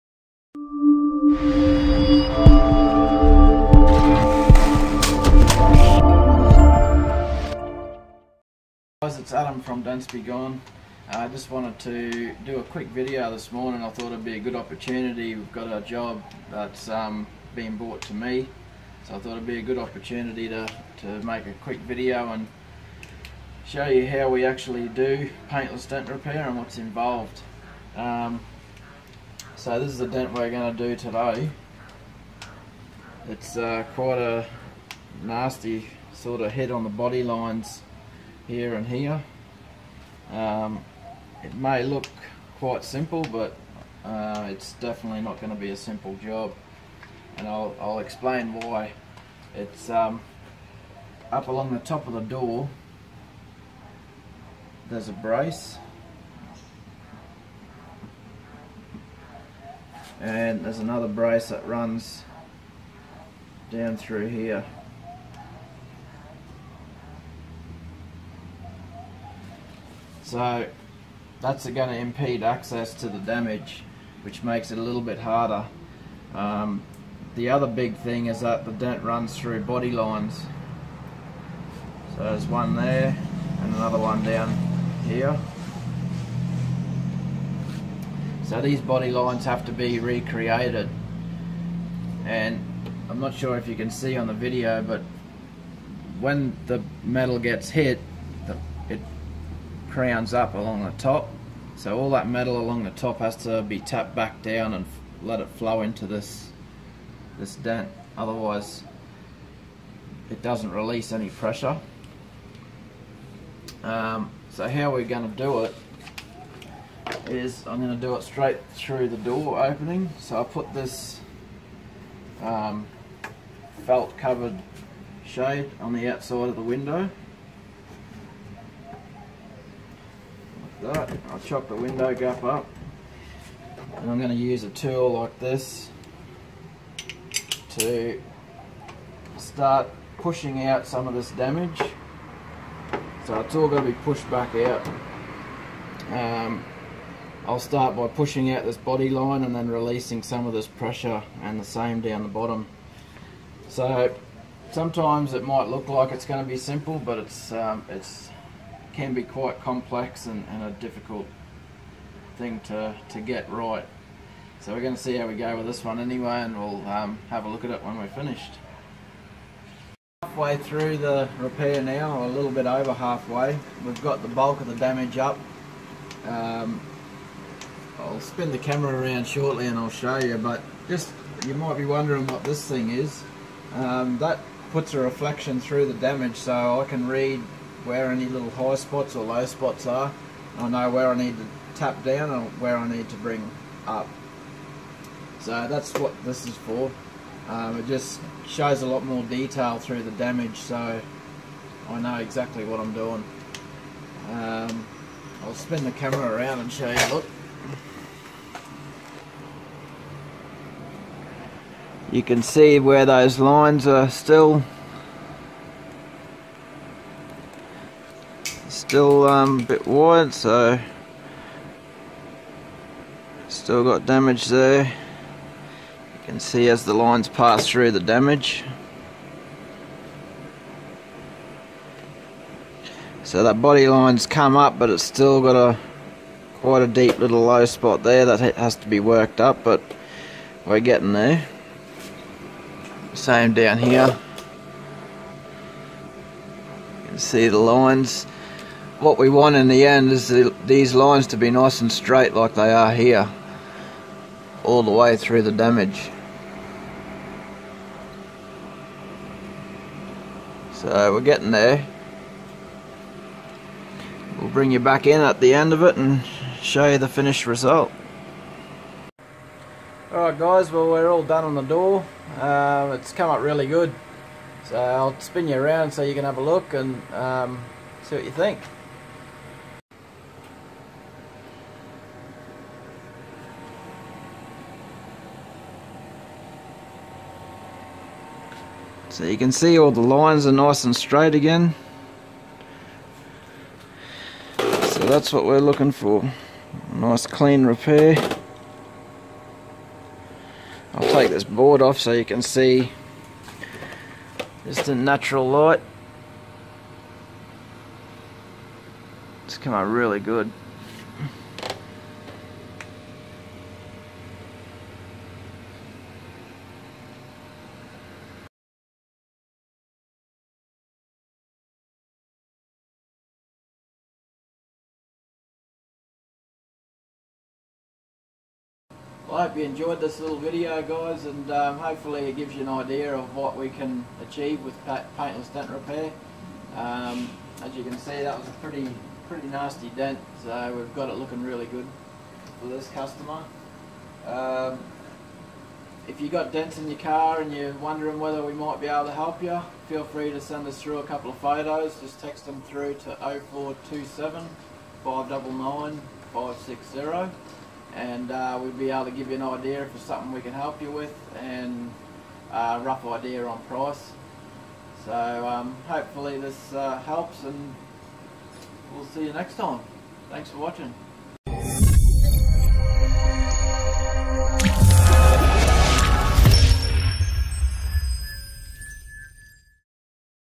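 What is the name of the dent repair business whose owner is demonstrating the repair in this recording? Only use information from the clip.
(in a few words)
Dents-B-Gone.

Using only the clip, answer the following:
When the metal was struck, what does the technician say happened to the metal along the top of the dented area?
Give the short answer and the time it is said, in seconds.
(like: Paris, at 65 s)
It crowns up, at 99 s.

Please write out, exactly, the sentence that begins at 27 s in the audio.
Um, so this is the dent we're going to do today.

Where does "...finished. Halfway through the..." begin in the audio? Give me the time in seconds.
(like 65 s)
168 s.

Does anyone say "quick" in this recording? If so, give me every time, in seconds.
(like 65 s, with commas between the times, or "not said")
12 s, 21 s.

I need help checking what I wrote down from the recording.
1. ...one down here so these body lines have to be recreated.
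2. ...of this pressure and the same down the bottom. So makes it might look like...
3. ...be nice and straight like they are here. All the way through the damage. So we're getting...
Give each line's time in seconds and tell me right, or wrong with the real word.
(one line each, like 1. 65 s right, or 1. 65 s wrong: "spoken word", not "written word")
1. 83 s right
2. 150 s wrong: "sometimes", not "makes"
3. 251 s right.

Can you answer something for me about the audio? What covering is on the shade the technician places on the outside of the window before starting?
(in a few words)
Felt.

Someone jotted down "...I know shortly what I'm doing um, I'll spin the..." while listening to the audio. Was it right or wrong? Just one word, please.
wrong.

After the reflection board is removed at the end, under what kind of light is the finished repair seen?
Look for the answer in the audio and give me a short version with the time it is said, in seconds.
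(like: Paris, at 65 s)
Natural light, at 304 s.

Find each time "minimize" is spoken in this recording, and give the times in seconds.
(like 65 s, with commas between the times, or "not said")
not said.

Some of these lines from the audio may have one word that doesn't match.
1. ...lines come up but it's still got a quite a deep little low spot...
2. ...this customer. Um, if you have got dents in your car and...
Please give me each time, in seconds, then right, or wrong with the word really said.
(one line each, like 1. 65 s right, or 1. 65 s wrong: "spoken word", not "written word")
1. 233 s right
2. 342 s right.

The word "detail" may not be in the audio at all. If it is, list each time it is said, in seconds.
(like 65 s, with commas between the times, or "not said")
199 s.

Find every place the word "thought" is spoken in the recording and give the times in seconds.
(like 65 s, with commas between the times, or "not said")
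13 s, 19 s.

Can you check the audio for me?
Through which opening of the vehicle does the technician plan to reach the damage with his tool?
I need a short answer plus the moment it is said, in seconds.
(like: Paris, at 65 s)
The door opening, at 119 s.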